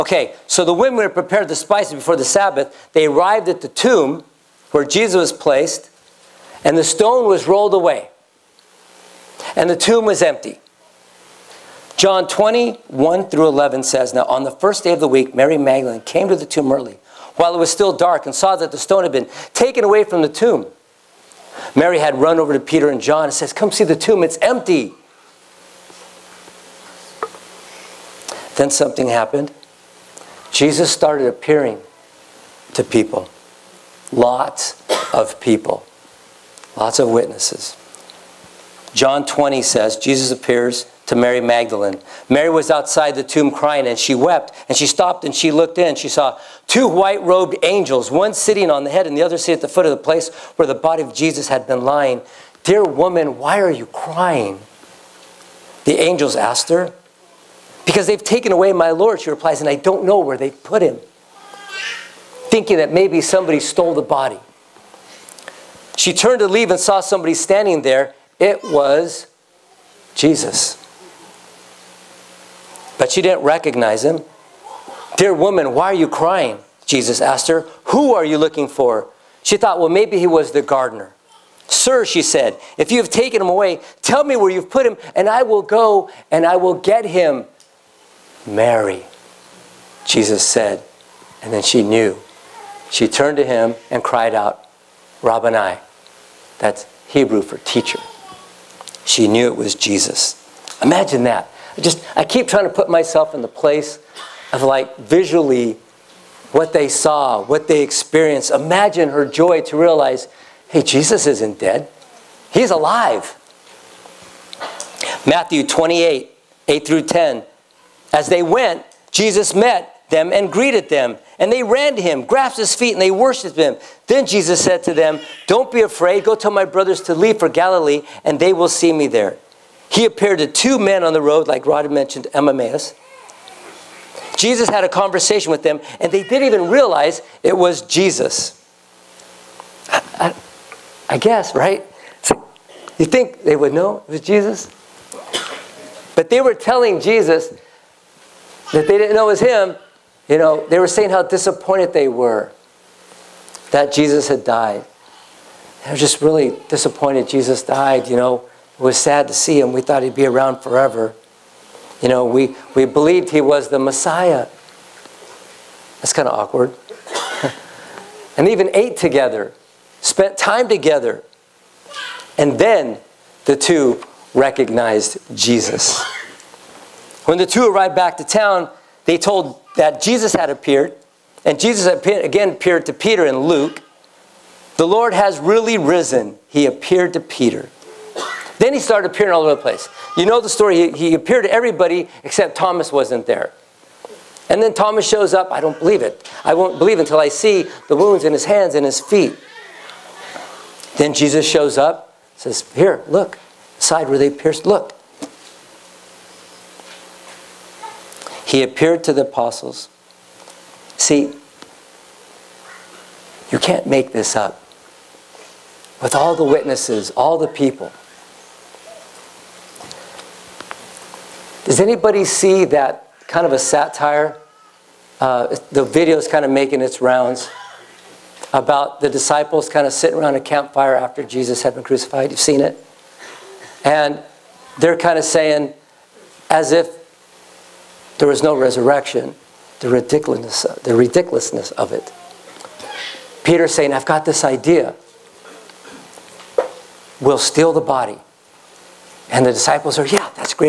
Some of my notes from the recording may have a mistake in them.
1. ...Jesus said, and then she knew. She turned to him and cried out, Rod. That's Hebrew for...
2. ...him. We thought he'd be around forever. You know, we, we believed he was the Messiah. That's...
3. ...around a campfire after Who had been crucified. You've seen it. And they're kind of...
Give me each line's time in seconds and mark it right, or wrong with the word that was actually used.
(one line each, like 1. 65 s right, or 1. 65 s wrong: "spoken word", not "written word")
1. 90 s wrong: "Rabboni", not "Rod"
2. 159 s right
3. 230 s wrong: "Jesus", not "Who".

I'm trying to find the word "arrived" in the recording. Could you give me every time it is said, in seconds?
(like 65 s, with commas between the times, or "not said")
3 s, 177 s.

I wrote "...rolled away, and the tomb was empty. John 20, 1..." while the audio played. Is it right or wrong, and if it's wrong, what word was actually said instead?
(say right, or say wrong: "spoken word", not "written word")
right.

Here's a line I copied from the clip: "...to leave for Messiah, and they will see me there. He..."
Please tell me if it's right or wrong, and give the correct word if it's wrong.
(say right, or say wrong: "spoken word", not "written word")
wrong: "Galilee", not "Messiah".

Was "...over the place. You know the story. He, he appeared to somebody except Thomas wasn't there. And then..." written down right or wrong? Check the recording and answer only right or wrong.
wrong.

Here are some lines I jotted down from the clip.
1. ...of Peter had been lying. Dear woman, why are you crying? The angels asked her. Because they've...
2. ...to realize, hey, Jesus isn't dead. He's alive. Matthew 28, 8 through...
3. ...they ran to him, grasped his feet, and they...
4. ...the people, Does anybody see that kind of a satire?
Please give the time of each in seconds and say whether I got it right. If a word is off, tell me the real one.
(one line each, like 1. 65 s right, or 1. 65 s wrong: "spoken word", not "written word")
1. 51 s wrong: "Jesus", not "Peter"
2. 109 s right
3. 121 s right
4. 217 s right.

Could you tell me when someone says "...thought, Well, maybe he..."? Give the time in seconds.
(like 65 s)
79 s.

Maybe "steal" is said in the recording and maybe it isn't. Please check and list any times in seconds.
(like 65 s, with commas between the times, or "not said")
247 s.